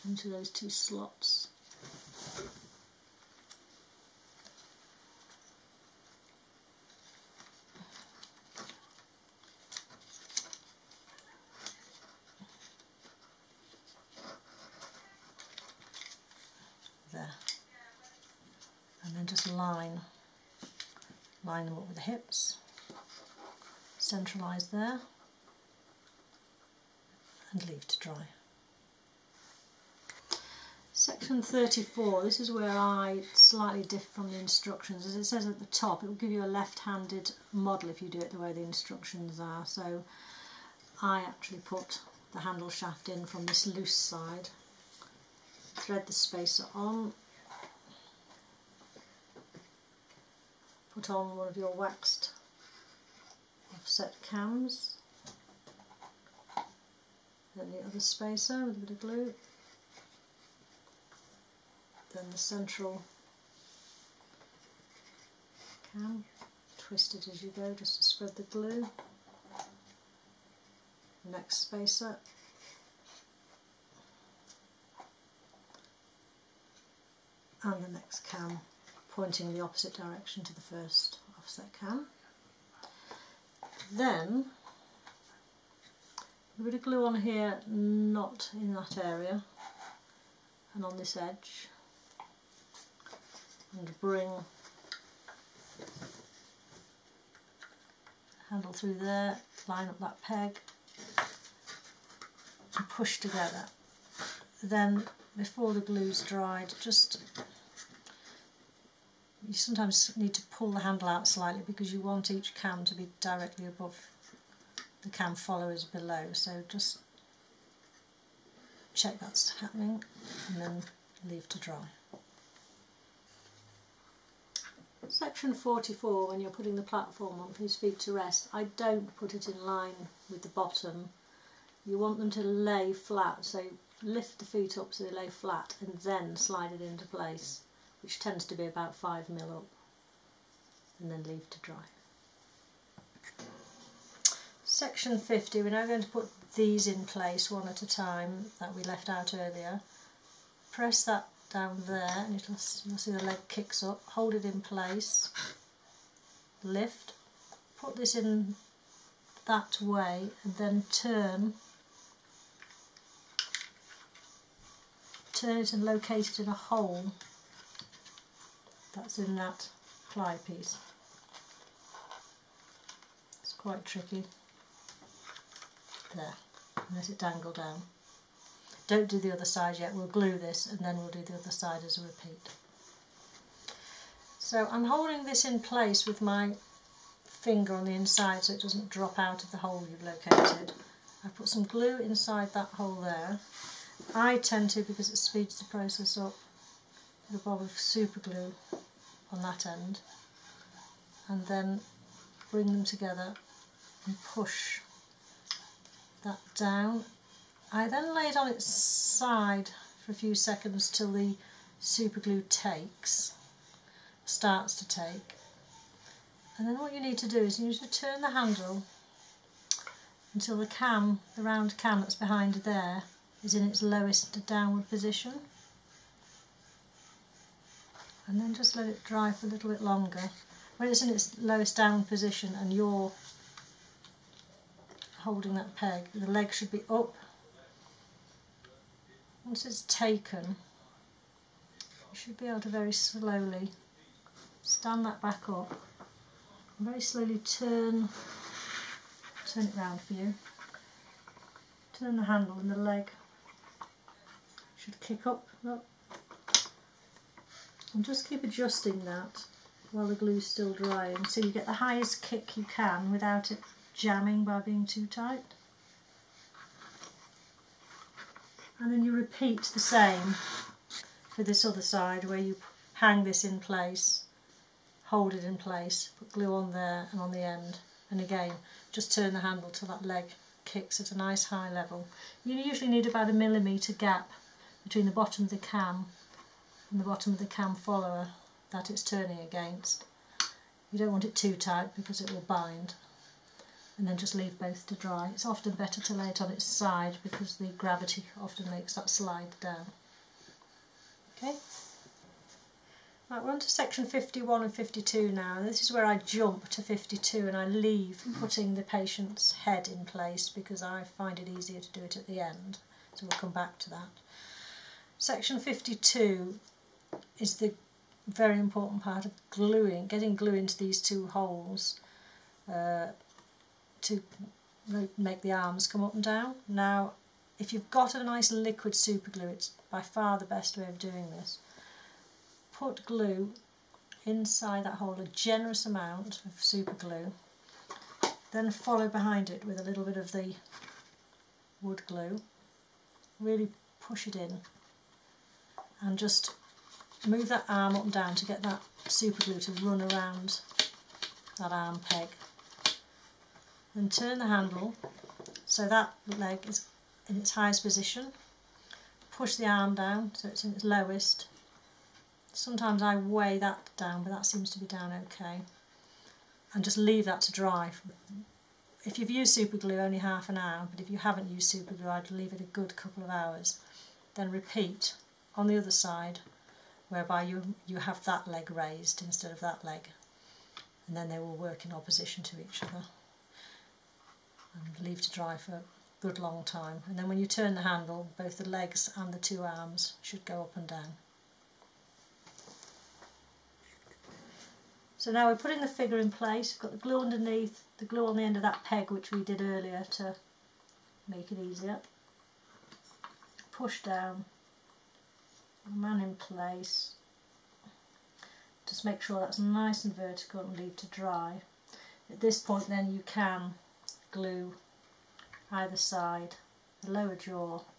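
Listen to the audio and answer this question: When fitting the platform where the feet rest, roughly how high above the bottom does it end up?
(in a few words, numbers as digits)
5 mil.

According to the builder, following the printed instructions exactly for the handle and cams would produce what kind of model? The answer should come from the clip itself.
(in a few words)
left-handed model.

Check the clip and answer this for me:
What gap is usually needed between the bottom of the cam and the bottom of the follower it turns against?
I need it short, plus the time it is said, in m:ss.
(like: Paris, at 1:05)
a millimetre, at 4:43.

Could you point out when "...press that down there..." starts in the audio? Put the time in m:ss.
2:30.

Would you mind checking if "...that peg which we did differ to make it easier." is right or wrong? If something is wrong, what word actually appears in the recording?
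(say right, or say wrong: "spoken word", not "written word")
wrong: "earlier", not "differ".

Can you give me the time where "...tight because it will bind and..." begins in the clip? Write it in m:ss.
4:51.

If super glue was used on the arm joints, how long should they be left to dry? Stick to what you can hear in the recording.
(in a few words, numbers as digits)
half an hour.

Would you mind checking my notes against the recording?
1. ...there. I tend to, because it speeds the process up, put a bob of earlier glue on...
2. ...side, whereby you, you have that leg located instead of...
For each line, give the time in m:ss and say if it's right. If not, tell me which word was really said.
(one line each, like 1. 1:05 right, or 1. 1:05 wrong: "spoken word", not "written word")
1. 3:13 wrong: "super", not "earlier"
2. 6:15 wrong: "raised", not "located".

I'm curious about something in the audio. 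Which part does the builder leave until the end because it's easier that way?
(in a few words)
patient's head.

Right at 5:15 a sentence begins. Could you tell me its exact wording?
Section 52 is the very important part of gluing, getting glue into these two holes.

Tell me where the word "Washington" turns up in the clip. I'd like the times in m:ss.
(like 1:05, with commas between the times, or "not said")
not said.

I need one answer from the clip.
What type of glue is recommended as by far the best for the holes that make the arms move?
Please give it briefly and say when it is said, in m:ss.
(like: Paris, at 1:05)
liquid super glue, at 5:28.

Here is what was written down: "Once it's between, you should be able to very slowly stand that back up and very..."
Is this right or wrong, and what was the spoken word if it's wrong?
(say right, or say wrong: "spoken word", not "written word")
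wrong: "taken", not "between".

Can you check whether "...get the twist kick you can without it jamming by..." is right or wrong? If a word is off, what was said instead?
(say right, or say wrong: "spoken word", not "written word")
wrong: "highest", not "twist".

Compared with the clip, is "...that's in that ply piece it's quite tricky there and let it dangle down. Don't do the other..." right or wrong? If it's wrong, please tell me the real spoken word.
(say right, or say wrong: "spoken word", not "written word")
right.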